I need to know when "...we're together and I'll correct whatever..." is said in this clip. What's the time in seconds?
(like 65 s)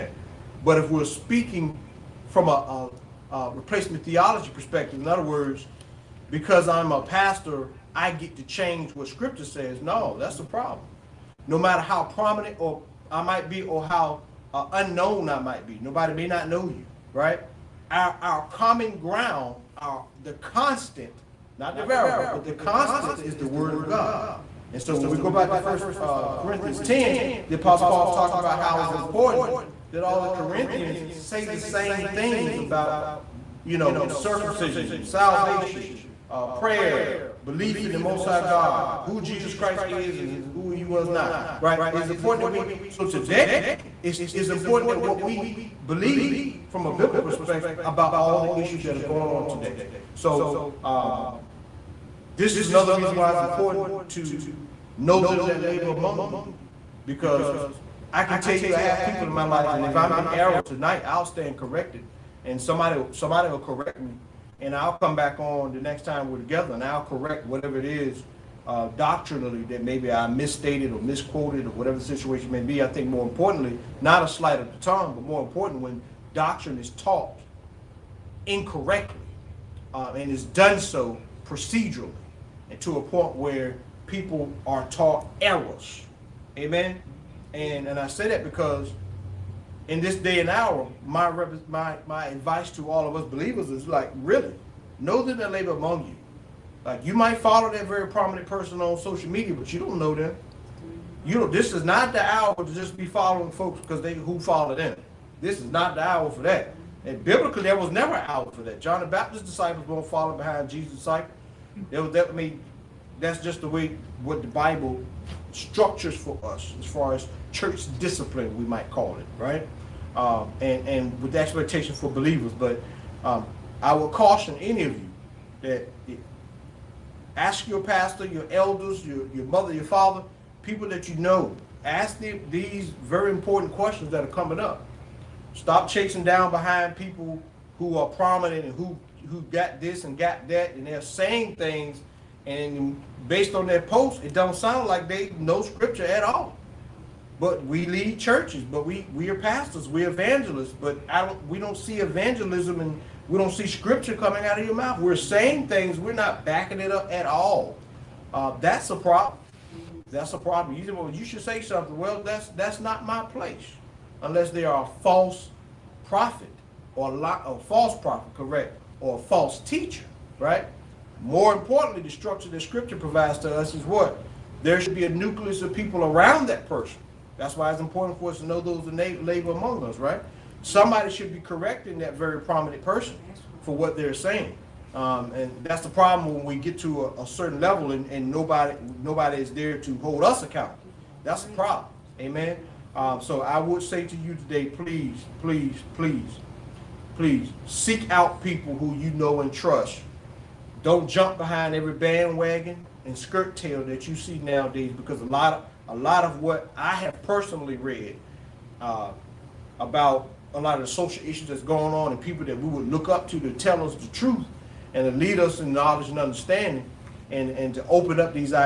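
66 s.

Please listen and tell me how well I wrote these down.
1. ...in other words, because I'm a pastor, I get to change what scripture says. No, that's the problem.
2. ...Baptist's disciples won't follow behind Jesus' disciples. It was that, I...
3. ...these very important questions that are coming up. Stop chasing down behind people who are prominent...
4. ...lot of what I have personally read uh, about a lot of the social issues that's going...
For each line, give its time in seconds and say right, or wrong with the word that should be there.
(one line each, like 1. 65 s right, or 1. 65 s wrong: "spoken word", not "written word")
1. 5 s right
2. 109 s right
3. 132 s right
4. 205 s right.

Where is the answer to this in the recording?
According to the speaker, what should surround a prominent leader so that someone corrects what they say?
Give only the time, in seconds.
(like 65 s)
175 s.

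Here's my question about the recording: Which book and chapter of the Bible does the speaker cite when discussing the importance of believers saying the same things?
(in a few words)
First Corinthians 10.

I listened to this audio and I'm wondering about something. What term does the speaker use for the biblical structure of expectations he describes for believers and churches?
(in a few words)
church discipline.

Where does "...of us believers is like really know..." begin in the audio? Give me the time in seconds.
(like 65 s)
93 s.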